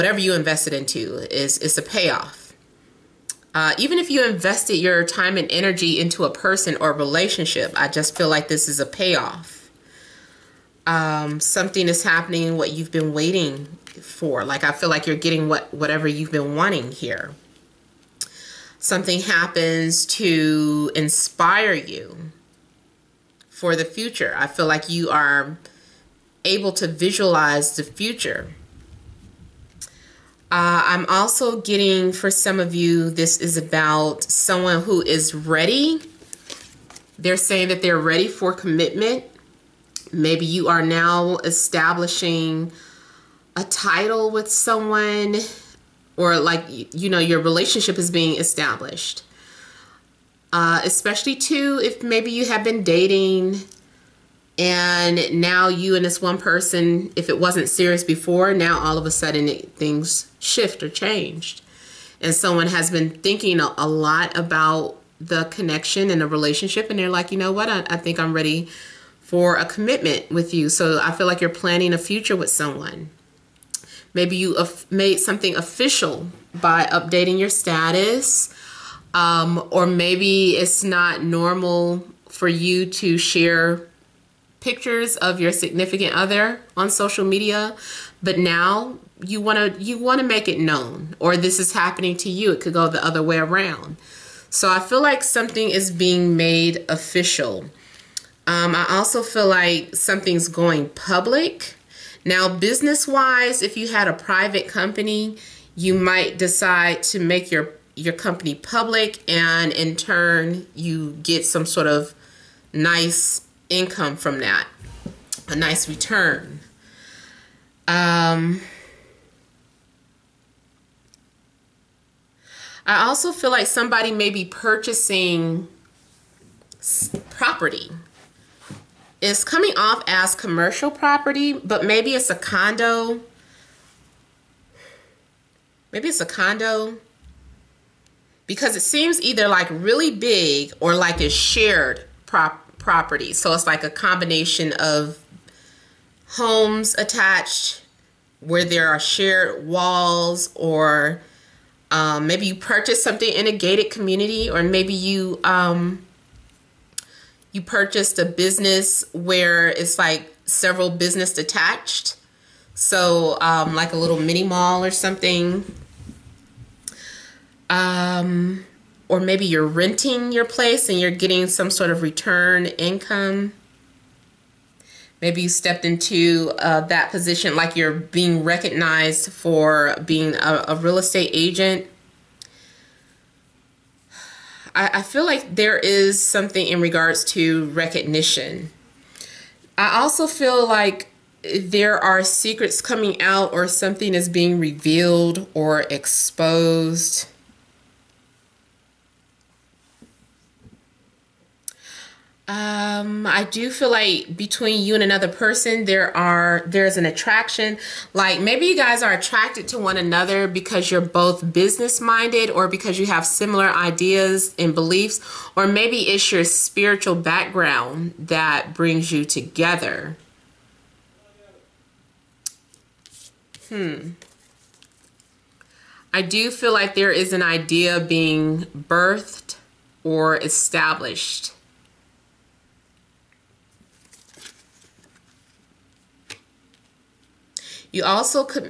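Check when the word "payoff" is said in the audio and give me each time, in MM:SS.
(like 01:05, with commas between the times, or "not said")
00:01, 00:08.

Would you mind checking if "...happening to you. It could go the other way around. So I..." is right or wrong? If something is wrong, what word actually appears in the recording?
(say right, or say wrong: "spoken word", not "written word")
right.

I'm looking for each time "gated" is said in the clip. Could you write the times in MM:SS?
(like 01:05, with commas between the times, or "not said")
02:33.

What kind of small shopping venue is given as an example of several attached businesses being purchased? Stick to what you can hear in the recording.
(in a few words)
a little mini mall.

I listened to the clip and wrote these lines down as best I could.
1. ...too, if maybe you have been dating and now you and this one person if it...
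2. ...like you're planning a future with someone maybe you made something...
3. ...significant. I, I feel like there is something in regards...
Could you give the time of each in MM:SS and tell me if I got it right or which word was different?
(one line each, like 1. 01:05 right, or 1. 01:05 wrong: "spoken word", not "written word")
1. 00:51 right
2. 01:11 right
3. 03:01 wrong: "agent", not "significant".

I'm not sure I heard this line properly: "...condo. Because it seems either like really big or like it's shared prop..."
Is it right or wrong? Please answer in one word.
right.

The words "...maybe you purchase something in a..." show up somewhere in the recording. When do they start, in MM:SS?
02:32.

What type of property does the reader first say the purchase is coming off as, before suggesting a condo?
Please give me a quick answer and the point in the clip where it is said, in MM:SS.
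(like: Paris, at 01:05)
commercial property, at 02:10.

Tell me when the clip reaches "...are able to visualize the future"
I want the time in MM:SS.
00:25.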